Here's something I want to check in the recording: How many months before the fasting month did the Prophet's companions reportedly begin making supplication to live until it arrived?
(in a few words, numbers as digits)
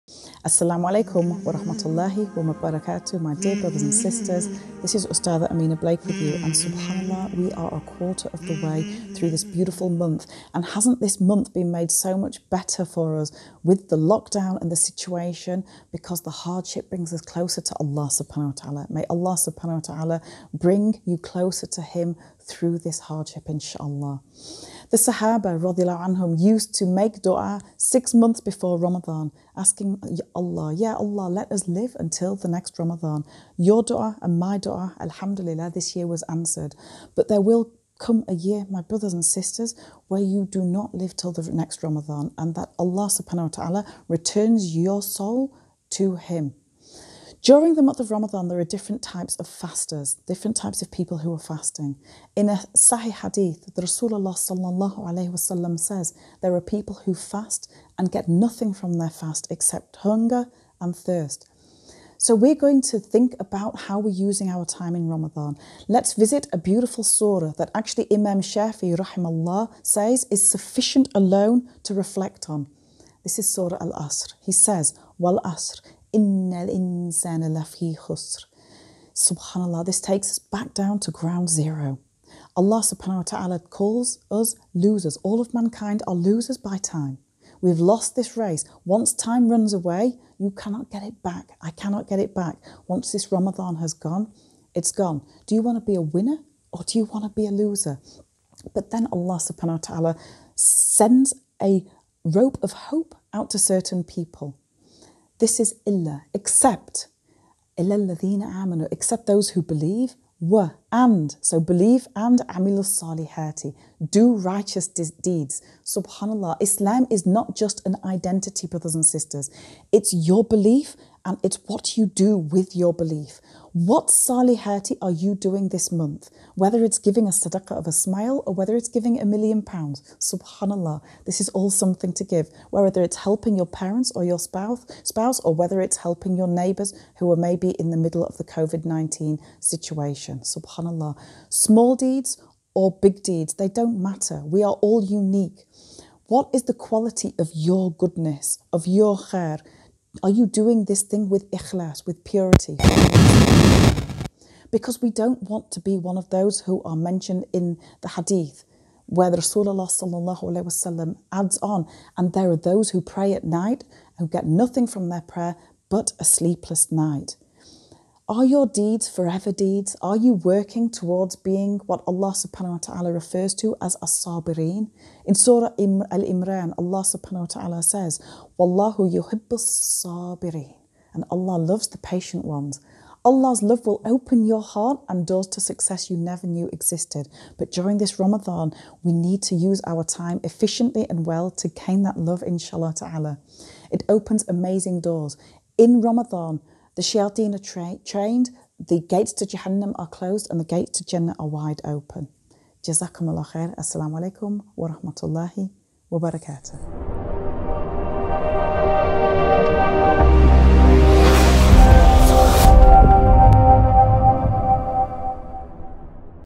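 6.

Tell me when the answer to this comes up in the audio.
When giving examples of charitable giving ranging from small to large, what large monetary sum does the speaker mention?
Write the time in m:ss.
2:09.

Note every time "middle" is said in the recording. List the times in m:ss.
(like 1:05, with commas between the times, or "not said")
2:17.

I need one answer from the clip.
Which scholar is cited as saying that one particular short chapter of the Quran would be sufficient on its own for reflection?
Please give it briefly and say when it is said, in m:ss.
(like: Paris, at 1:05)
Imam Shafi, at 1:08.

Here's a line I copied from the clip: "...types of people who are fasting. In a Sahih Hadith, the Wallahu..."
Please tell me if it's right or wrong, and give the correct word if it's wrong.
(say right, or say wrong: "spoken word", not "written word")
wrong: "Rasulullah", not "Wallahu".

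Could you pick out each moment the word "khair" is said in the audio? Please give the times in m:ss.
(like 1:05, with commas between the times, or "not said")
2:29, 3:23.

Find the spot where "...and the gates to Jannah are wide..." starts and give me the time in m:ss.
3:20.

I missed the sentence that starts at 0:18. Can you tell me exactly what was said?
May Allah subhanahu wa ta'ala bring you closer to Him through this hardship, inshallah.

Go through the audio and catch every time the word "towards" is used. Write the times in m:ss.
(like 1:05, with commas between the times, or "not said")
2:50.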